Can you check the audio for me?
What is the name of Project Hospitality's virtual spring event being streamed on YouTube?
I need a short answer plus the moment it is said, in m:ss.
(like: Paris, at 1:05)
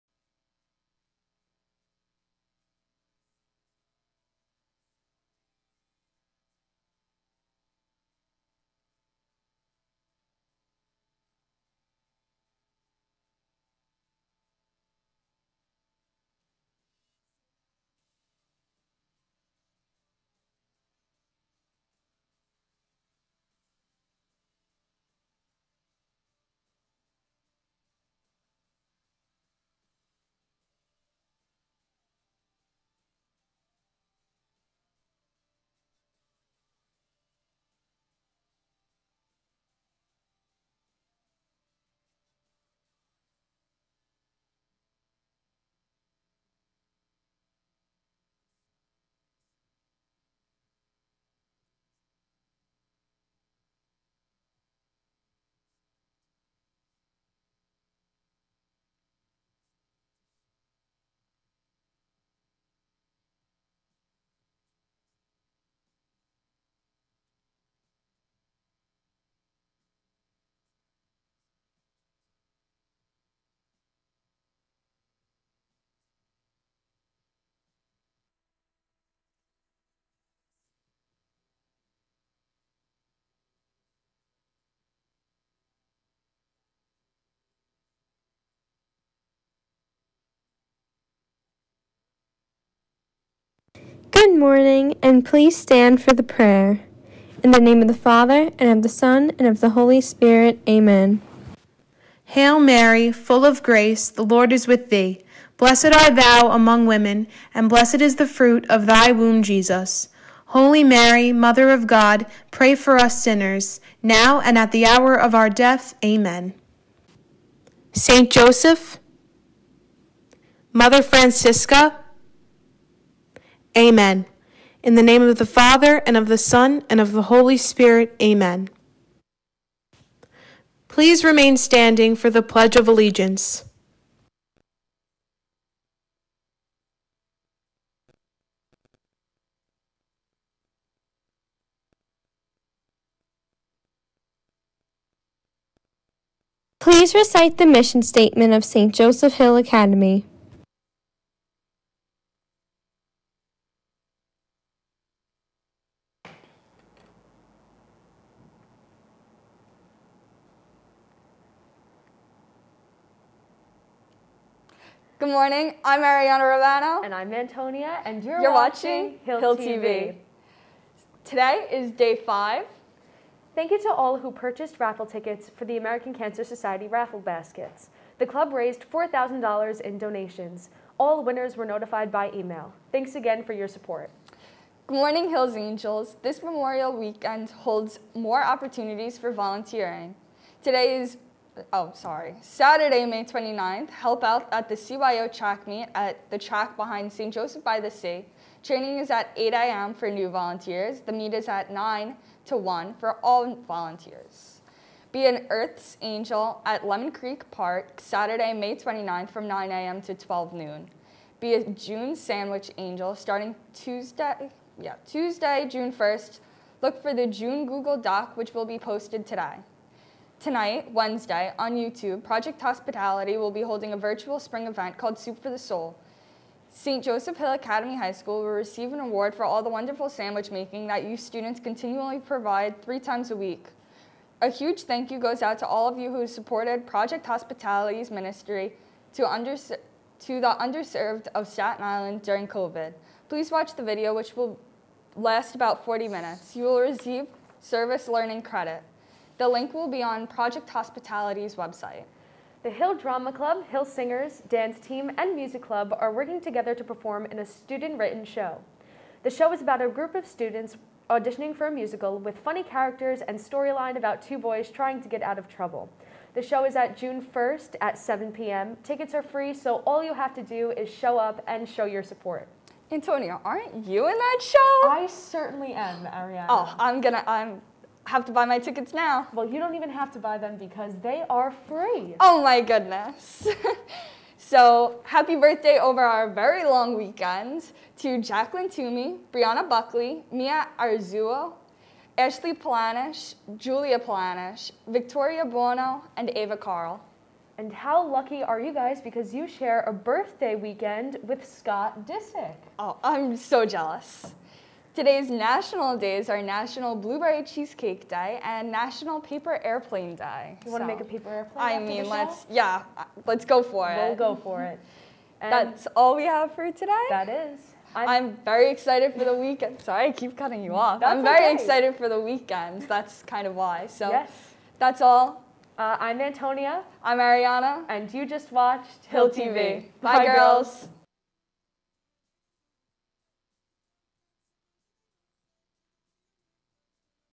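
Soup for the Soul, at 3:45.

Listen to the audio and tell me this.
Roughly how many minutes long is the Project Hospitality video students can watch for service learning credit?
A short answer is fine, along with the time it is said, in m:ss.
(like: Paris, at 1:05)
40, at 4:05.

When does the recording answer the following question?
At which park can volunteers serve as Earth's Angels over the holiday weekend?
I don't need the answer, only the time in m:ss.
3:26.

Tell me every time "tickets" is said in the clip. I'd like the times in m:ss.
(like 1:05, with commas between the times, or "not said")
2:55, 4:28, 4:38.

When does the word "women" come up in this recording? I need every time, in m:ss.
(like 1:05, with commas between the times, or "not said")
1:46.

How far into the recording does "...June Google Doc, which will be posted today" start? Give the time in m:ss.
3:37.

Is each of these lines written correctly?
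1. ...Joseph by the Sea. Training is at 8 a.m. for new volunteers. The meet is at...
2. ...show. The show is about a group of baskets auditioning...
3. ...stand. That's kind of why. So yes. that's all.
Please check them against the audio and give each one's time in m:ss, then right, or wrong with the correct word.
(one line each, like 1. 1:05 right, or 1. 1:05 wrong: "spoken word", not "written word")
1. 3:17 right
2. 4:18 wrong: "students", not "baskets"
3. 5:22 wrong: "weekend", not "stand".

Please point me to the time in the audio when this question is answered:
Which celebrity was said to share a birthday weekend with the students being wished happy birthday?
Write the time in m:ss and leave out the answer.
5:01.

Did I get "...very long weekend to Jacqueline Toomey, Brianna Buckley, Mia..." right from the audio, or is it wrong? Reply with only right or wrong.
right.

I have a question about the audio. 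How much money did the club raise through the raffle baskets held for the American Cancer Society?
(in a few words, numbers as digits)
$4,000.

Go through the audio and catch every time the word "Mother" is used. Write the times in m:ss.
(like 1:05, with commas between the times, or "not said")
1:51, 2:00.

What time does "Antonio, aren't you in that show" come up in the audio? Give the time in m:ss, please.
4:32.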